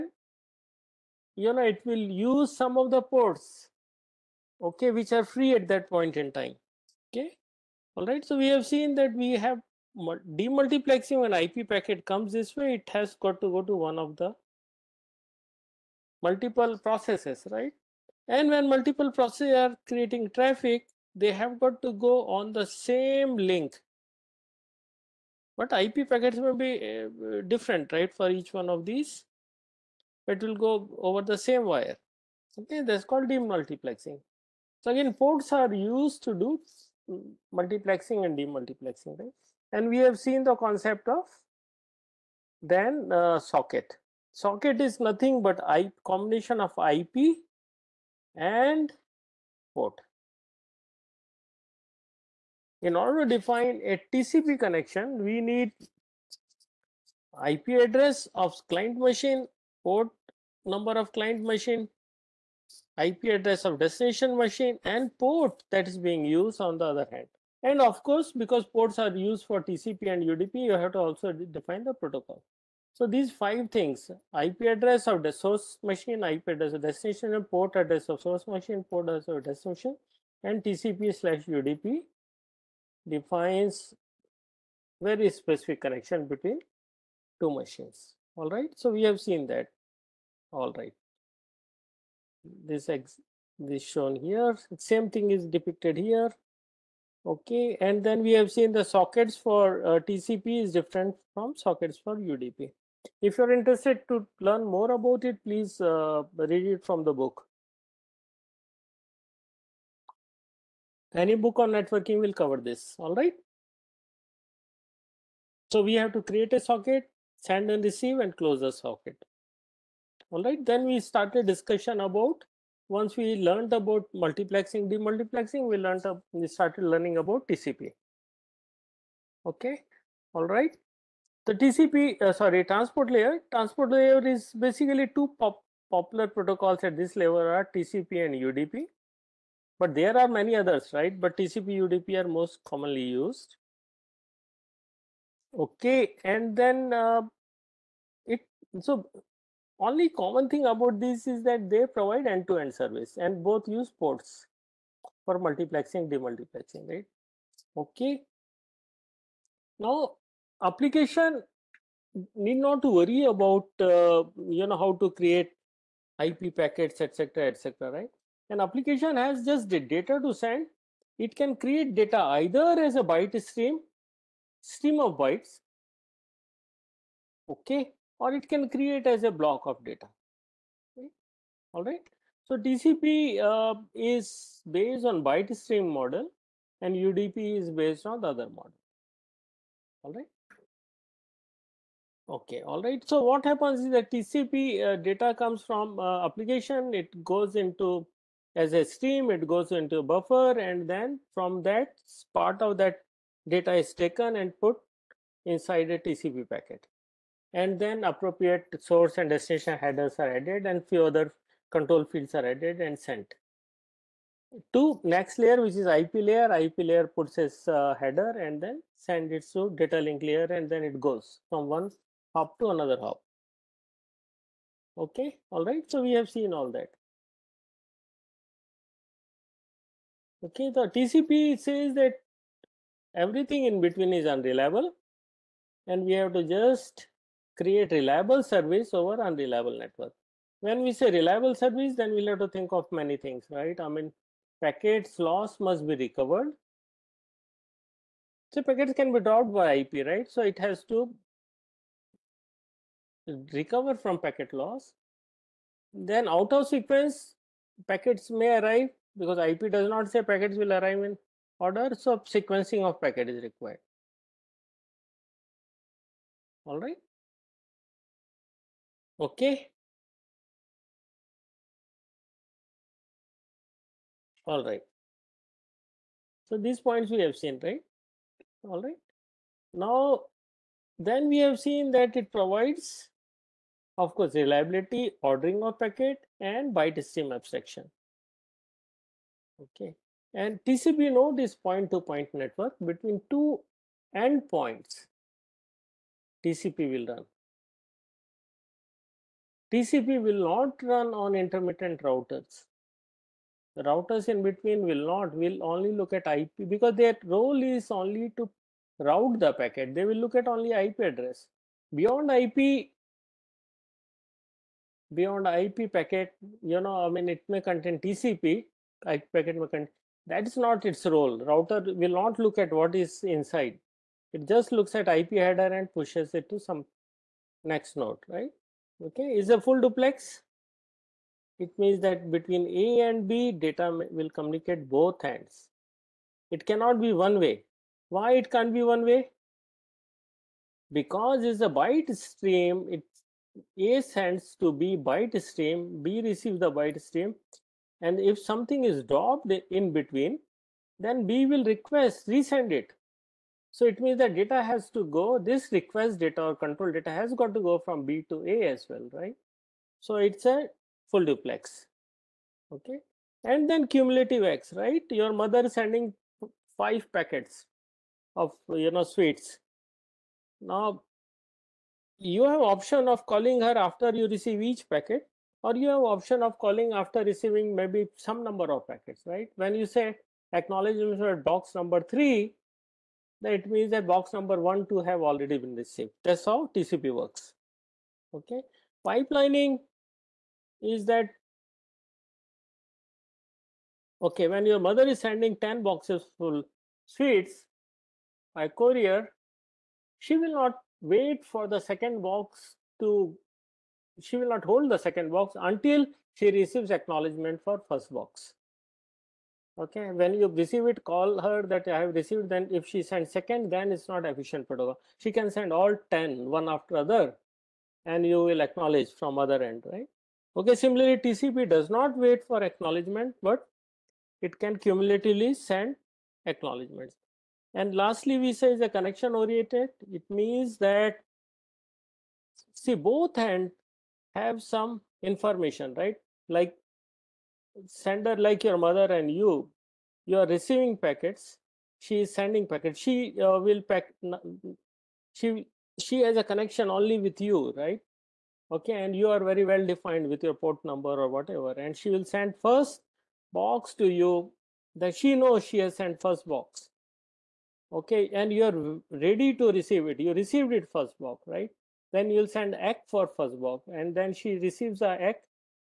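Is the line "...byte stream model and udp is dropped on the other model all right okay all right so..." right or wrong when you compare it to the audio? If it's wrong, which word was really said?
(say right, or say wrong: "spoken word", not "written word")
wrong: "based", not "dropped".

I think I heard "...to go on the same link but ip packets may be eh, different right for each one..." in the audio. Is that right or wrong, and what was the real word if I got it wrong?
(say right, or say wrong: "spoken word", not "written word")
right.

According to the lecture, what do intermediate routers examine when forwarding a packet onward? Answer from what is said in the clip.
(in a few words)
IP header.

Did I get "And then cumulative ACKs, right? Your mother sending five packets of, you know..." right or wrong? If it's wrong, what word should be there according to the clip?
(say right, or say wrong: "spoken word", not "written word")
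right.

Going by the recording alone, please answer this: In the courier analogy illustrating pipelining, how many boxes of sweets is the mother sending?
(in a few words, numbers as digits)
10.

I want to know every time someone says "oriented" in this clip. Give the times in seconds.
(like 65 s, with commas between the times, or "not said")
429 s.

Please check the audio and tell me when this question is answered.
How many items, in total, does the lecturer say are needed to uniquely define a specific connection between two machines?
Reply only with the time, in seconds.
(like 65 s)
73 s.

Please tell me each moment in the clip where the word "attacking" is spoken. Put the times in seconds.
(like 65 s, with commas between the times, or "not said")
not said.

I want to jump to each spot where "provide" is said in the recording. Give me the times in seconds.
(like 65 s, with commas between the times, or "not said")
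151 s, 282 s.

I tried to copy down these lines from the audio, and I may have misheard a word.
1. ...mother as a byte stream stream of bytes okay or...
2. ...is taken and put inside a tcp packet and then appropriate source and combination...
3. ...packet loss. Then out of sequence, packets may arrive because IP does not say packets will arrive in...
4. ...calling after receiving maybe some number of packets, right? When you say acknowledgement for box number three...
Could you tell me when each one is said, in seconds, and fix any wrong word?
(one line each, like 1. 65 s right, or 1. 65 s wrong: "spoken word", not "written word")
1. 172 s wrong: "either", not "mother"
2. 203 s wrong: "destination", not "combination"
3. 254 s right
4. 376 s right.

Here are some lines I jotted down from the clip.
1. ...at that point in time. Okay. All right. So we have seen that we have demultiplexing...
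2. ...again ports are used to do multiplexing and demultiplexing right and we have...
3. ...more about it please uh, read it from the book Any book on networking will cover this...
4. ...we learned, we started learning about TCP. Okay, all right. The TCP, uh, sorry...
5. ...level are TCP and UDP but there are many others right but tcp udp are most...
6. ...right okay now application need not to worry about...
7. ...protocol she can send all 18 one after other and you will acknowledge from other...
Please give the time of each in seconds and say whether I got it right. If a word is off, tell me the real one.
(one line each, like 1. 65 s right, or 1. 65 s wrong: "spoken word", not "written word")
1. 5 s right
2. 34 s right
3. 104 s right
4. 125 s right
5. 137 s right
6. 156 s right
7. 414 s wrong: "10", not "18".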